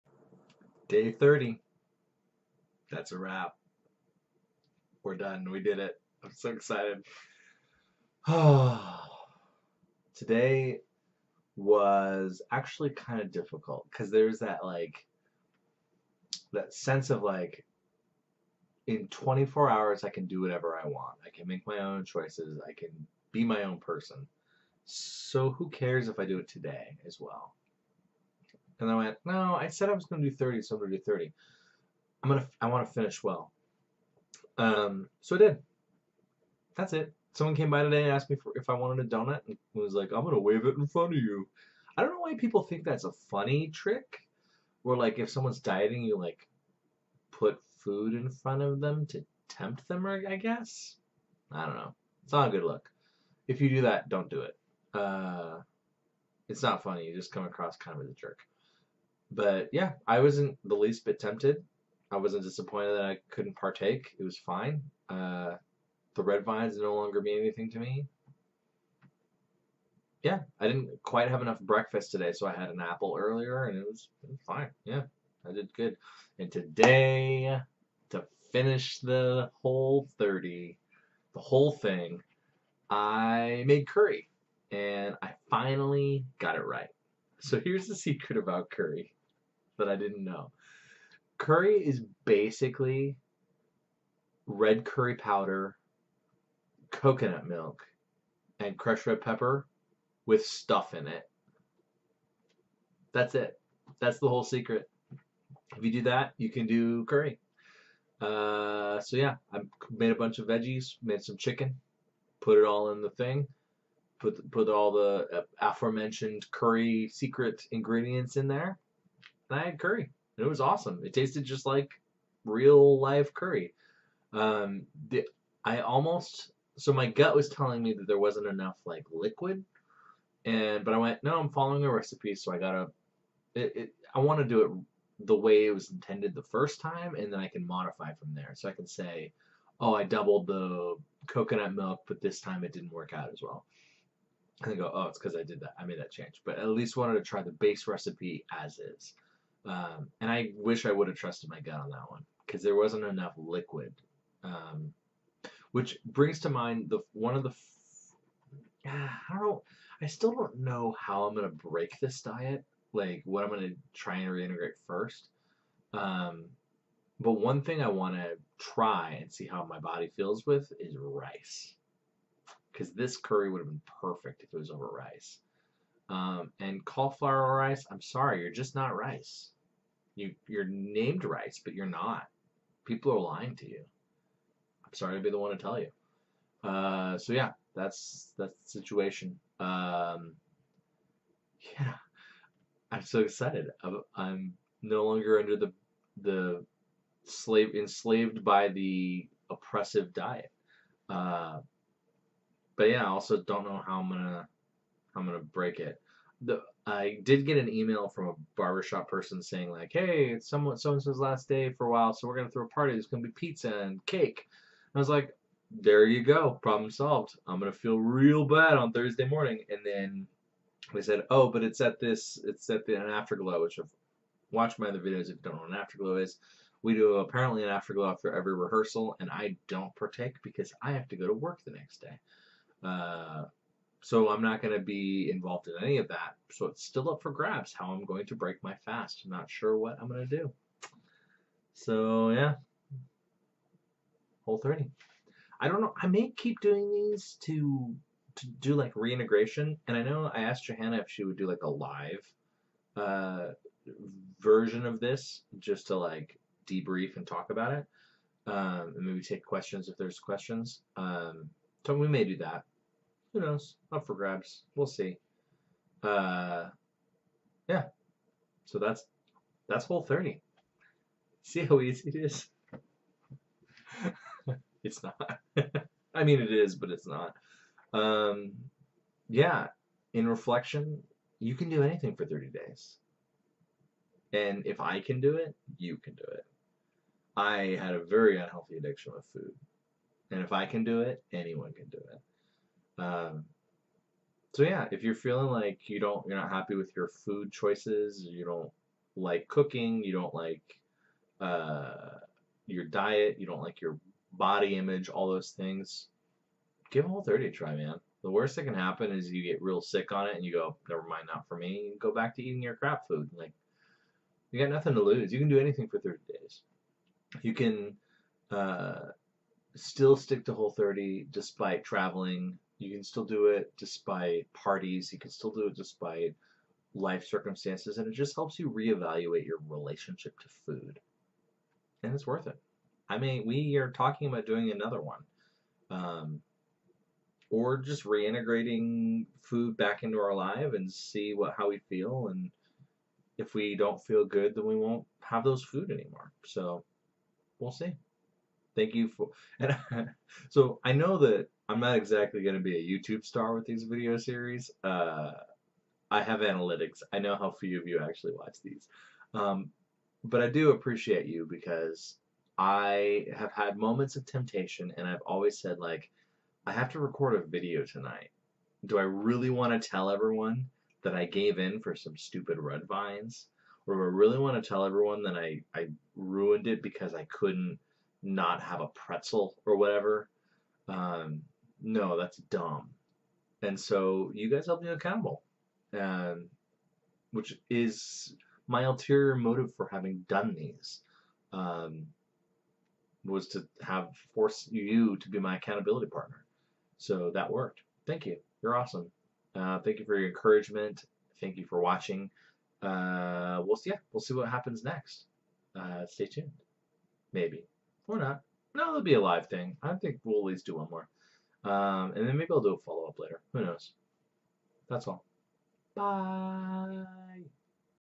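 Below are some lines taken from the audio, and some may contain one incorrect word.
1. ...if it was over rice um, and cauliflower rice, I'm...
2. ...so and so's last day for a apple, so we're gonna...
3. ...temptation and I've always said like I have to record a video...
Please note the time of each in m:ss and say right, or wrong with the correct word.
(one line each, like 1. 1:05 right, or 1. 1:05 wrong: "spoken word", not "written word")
1. 2:54 right
2. 3:30 wrong: "while", not "apple"
3. 6:04 right.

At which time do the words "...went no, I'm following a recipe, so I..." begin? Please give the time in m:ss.
2:10.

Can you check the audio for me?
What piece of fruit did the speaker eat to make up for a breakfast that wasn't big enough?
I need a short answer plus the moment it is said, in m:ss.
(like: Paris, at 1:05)
An apple, at 1:12.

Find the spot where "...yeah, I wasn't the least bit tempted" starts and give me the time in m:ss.
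0:59.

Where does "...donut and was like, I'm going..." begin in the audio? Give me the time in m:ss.
0:39.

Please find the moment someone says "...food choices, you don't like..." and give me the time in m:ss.
4:57.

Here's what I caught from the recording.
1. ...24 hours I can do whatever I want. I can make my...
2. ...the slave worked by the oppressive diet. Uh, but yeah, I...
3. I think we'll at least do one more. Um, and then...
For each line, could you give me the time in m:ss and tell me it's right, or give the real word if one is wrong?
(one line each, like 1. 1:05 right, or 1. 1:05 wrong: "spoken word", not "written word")
1. 0:19 right
2. 3:16 wrong: "enslaved", not "worked"
3. 6:49 right.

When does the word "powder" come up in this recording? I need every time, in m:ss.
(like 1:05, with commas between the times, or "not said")
1:35.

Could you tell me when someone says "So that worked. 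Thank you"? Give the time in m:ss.
6:36.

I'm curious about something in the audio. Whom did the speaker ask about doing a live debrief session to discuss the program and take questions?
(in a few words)
Johanna.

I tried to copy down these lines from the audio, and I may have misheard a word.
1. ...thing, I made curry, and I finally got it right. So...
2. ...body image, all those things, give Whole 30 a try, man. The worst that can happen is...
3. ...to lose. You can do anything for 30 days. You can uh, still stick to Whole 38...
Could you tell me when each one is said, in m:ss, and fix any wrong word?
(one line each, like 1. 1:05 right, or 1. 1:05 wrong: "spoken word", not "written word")
1. 1:21 right
2. 5:04 right
3. 5:14 wrong: "30", not "38".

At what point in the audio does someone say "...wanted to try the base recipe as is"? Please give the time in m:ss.
2:26.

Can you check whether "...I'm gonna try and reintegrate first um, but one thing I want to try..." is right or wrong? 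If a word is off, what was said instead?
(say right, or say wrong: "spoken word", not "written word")
right.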